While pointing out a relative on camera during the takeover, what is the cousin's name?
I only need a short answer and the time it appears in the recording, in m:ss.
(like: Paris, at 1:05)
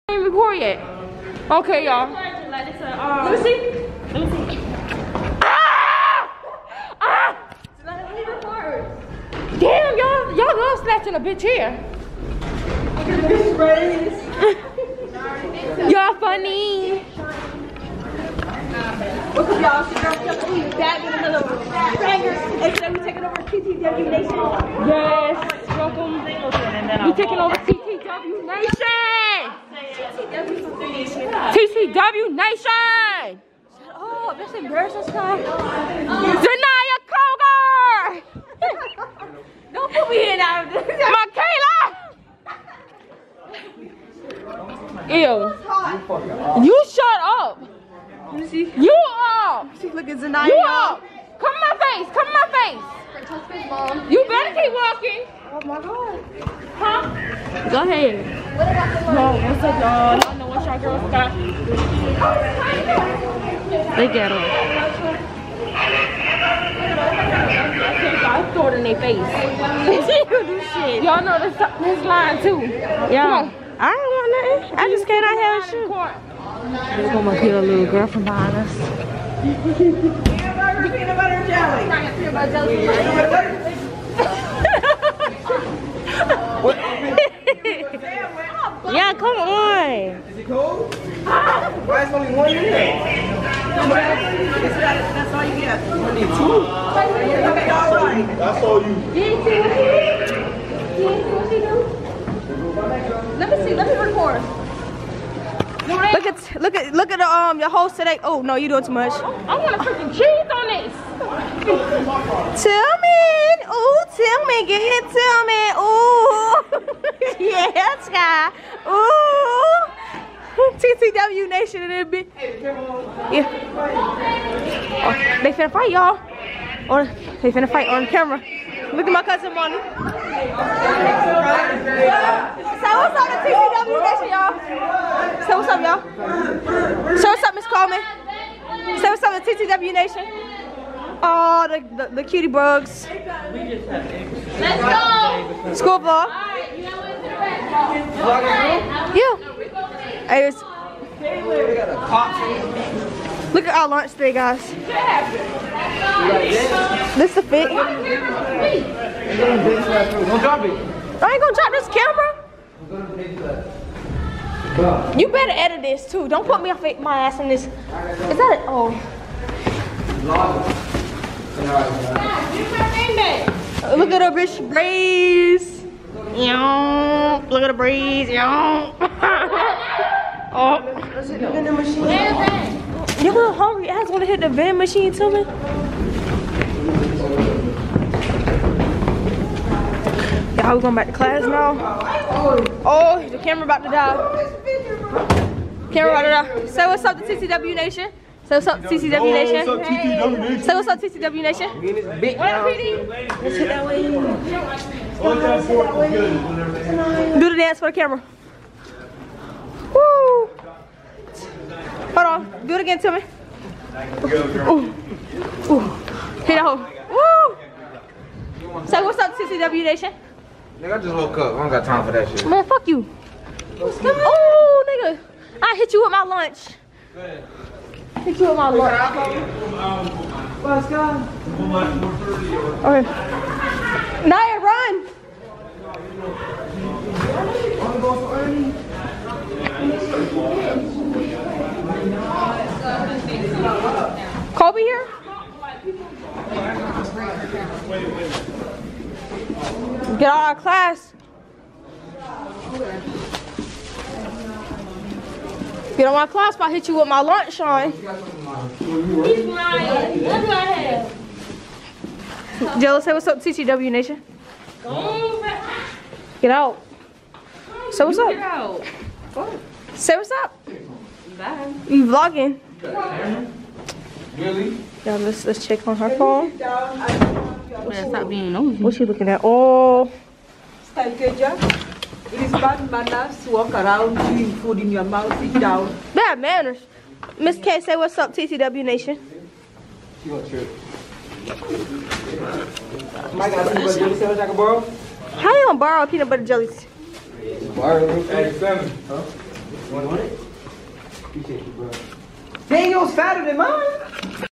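Monty, at 2:09.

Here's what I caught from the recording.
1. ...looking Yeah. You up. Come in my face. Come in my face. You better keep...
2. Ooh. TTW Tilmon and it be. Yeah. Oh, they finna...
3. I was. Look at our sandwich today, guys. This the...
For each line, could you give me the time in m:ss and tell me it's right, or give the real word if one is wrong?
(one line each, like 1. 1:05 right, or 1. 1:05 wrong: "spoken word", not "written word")
1. 0:49 wrong: "Zanaya", not "Yeah"
2. 1:58 wrong: "Nation", not "Tilmon"
3. 2:30 wrong: "lunch", not "sandwich".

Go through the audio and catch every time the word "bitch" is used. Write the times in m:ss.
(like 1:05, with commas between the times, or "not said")
0:11, 2:54.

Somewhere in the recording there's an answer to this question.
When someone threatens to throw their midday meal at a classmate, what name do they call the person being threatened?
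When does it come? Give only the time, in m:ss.
4:17.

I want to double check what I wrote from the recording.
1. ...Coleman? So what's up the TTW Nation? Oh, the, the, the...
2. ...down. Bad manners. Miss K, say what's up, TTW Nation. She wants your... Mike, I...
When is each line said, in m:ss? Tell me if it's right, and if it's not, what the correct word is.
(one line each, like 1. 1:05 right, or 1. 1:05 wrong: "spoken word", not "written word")
1. 2:17 right
2. 4:45 right.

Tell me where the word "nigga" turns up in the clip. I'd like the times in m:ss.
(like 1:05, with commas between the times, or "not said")
3:40, 3:44.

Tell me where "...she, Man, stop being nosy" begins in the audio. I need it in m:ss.
4:37.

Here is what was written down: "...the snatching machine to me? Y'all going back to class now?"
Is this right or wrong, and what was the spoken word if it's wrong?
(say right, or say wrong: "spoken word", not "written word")
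wrong: "vending", not "snatching".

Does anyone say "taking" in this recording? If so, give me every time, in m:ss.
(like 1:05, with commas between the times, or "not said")
0:23, 0:27.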